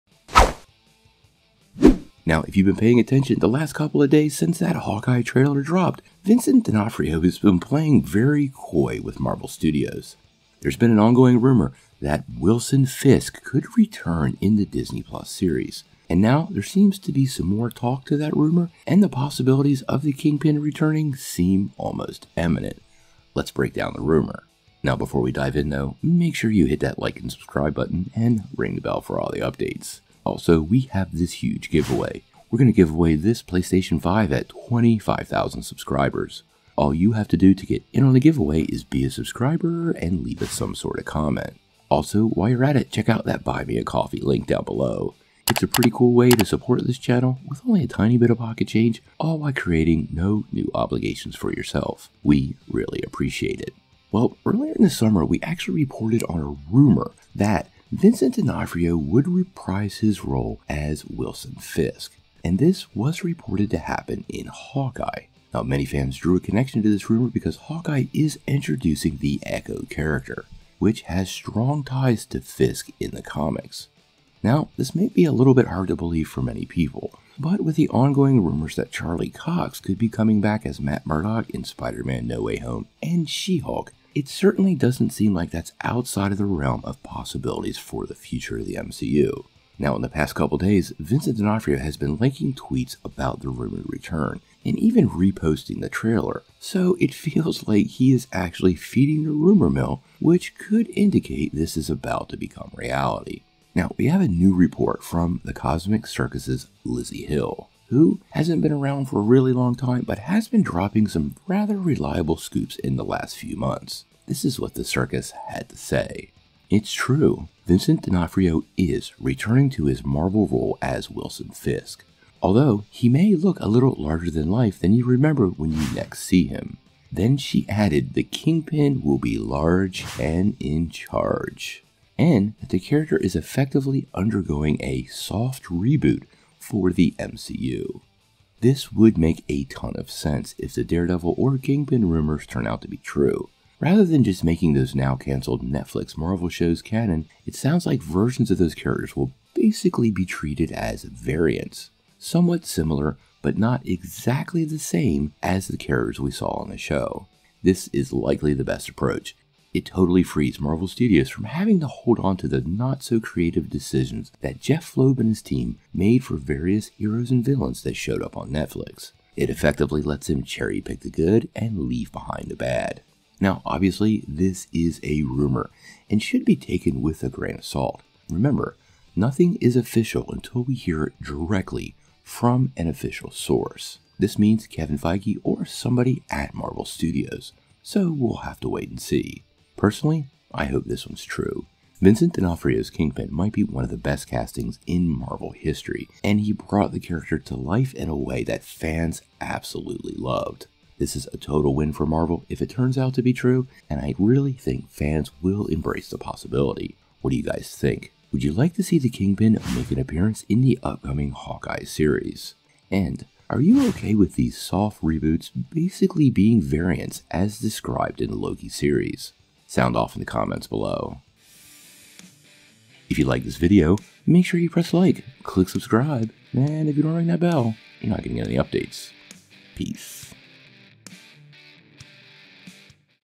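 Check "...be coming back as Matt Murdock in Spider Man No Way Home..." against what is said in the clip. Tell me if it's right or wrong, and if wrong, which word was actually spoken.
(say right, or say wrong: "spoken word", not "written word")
right.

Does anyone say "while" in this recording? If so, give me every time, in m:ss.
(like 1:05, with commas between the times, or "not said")
0:42, 0:49.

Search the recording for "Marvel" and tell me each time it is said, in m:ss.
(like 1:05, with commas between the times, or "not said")
0:09, 2:00, 2:26, 2:40, 3:06, 3:15, 3:22.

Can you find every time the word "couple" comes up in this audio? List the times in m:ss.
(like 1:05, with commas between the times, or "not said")
0:03, 1:30.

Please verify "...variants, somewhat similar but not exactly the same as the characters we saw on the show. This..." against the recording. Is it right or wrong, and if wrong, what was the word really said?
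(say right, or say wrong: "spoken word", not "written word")
right.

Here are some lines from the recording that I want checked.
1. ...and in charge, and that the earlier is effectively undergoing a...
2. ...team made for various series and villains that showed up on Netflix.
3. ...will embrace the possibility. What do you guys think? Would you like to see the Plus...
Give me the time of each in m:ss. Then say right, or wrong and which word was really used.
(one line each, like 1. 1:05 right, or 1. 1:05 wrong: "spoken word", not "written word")
1. 2:10 wrong: "character", not "earlier"
2. 2:45 wrong: "heroes", not "series"
3. 3:25 wrong: "Kingpin", not "Plus".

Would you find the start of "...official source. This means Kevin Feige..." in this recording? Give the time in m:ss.
3:02.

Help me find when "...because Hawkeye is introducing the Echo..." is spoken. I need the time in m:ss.
1:07.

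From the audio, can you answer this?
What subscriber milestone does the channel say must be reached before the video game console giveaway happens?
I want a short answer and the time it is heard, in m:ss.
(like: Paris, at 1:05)
25,000, at 0:34.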